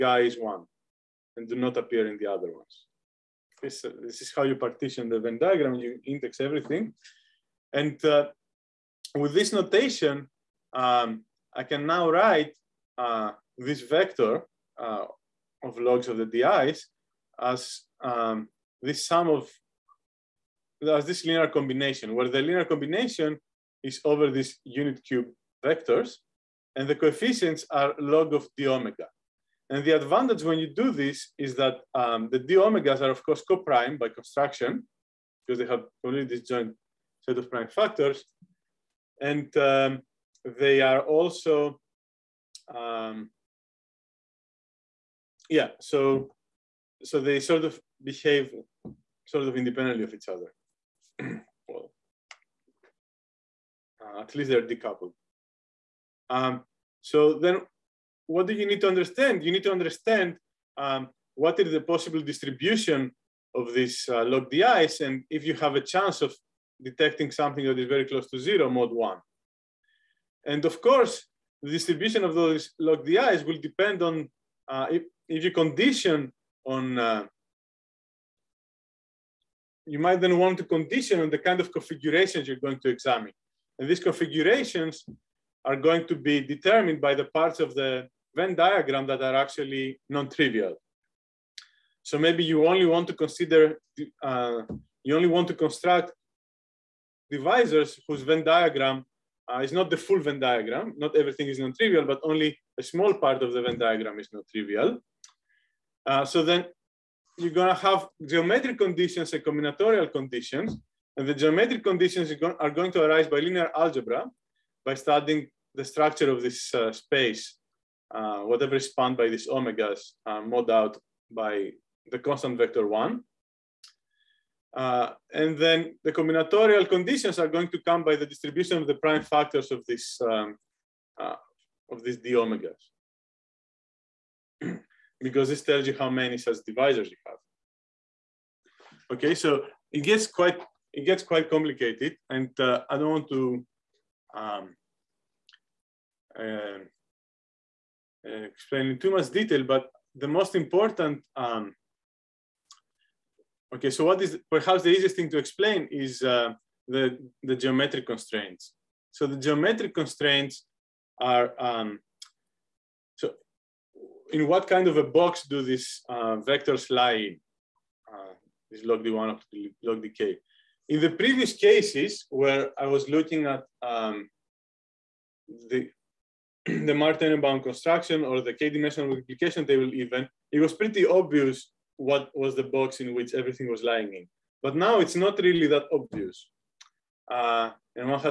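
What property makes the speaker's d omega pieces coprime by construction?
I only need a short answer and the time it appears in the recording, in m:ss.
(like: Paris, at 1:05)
disjoint set of prime factors, at 0:36.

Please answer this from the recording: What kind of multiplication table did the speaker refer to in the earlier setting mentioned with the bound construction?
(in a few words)
k-dimensional.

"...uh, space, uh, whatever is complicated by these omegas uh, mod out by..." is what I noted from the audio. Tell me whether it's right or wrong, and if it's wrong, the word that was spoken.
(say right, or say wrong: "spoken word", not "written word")
wrong: "spanned", not "complicated".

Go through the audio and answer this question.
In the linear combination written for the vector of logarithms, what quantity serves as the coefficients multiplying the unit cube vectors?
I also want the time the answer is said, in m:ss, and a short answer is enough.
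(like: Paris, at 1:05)
log of d omega, at 0:27.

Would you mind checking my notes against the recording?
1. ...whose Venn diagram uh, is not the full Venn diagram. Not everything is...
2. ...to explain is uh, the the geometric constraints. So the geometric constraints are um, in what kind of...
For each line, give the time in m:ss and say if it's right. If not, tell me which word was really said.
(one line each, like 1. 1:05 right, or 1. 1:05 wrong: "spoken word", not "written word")
1. 1:38 right
2. 2:35 right.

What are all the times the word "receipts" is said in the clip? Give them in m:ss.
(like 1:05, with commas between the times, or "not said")
not said.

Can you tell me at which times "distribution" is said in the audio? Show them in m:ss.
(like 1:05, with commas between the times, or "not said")
1:02, 1:11, 2:08.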